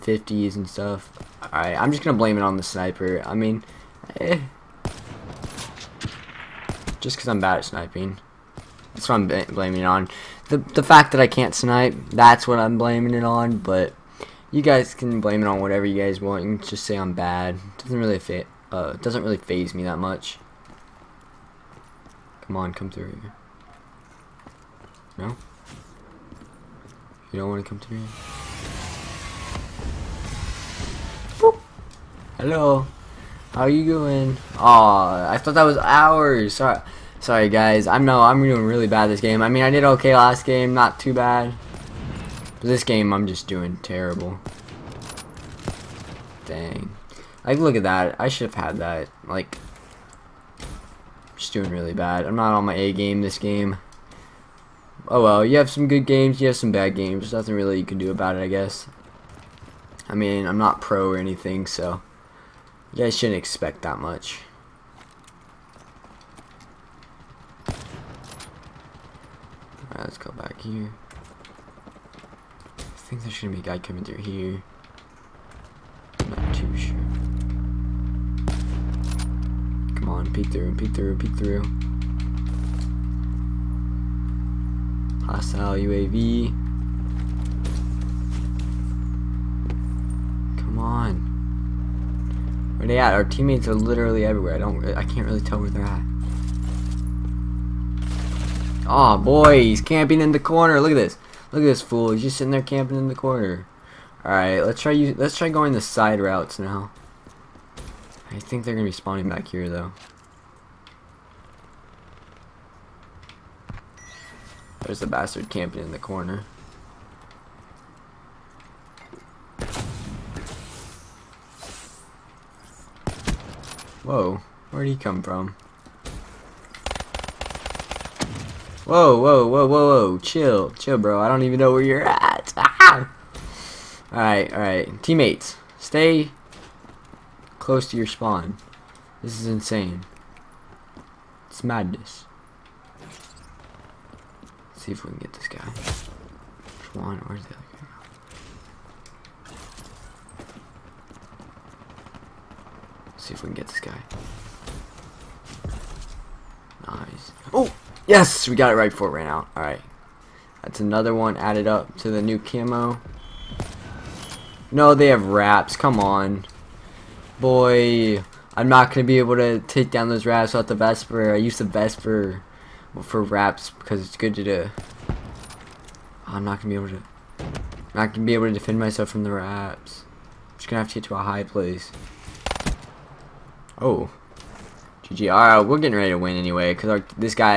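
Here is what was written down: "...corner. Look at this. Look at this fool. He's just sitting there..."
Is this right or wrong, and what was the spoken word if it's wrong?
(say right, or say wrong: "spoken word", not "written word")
right.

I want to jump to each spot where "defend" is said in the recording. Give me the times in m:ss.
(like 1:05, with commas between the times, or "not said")
2:58.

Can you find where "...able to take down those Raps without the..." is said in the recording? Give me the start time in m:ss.
2:49.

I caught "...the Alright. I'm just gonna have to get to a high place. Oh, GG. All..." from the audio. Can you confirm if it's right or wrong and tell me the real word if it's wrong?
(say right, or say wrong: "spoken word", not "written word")
wrong: "Raps", not "Alright".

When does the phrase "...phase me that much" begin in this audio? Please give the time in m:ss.
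0:19.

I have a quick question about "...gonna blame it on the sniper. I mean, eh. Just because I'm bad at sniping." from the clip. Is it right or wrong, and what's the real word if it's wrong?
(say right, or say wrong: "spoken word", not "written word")
right.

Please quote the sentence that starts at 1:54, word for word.
There's a bastard camping in the corner.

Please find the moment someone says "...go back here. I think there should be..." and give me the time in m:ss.
1:10.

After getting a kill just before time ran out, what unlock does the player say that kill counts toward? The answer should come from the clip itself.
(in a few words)
new camo.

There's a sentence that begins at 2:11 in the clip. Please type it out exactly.
I don't even know where you're at.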